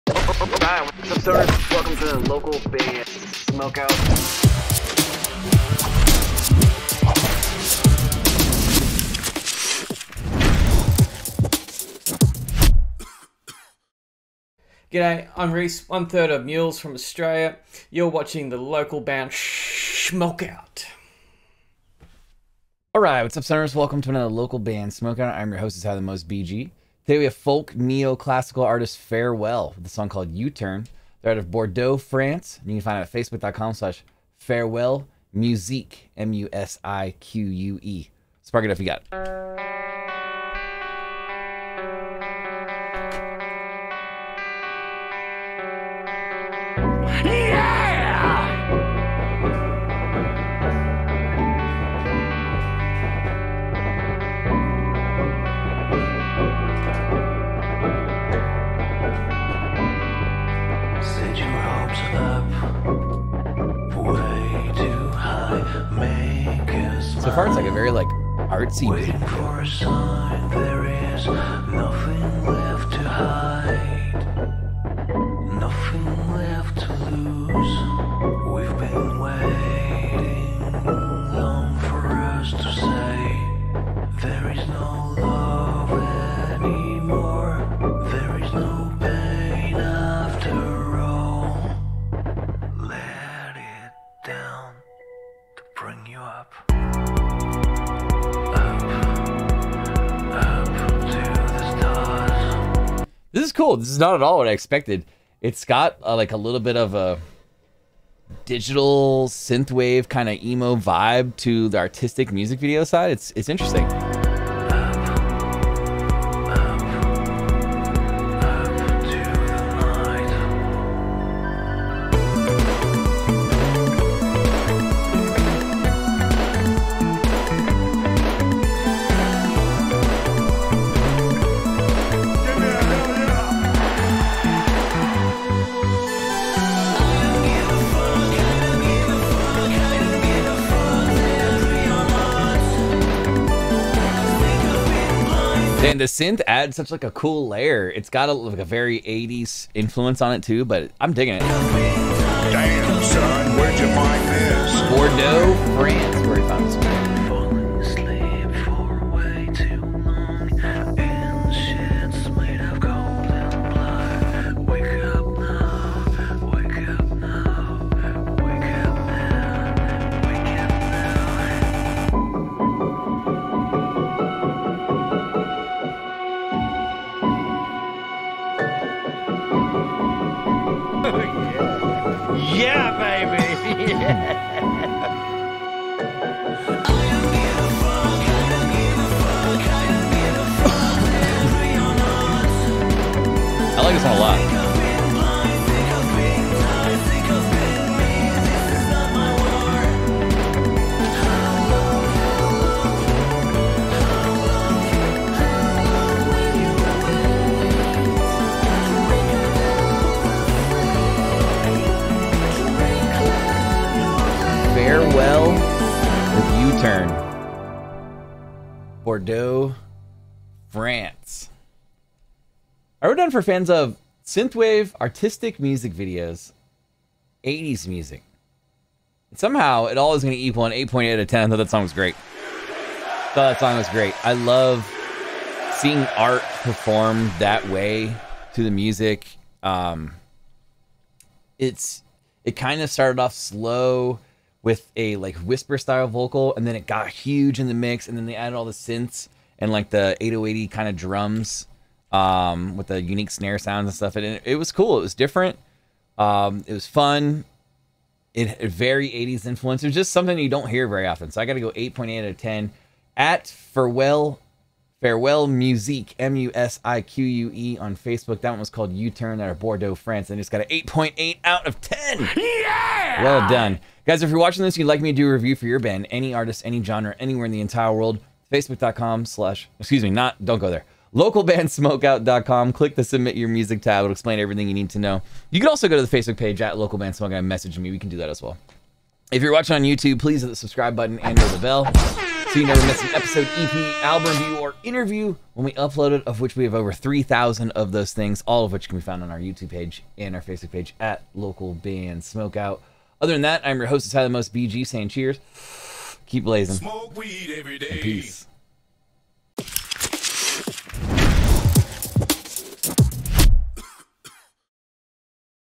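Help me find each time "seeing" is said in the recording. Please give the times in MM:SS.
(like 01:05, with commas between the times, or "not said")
03:55.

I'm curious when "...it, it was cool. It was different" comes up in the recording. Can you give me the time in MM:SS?
04:14.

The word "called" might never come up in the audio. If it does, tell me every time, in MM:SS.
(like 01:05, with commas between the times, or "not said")
00:30, 04:28.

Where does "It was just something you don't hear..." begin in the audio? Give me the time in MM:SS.
04:19.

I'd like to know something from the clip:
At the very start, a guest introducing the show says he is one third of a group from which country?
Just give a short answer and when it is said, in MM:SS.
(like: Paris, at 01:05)
Australia, at 00:16.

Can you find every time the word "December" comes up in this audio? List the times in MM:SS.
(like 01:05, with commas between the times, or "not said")
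not said.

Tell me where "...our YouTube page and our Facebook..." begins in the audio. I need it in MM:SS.
04:59.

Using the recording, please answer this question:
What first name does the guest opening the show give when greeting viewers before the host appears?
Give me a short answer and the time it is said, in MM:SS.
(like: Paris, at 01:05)
Reese, at 00:15.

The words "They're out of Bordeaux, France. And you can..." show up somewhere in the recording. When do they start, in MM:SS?
00:31.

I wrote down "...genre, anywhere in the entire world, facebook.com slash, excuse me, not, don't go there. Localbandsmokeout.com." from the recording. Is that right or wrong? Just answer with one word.
right.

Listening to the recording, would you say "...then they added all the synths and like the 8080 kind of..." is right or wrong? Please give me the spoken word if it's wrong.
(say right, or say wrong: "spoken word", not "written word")
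right.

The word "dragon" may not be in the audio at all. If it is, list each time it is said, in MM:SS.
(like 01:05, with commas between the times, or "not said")
not said.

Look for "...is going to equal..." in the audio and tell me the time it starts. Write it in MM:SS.
03:50.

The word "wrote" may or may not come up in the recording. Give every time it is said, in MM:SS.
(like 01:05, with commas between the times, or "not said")
03:43.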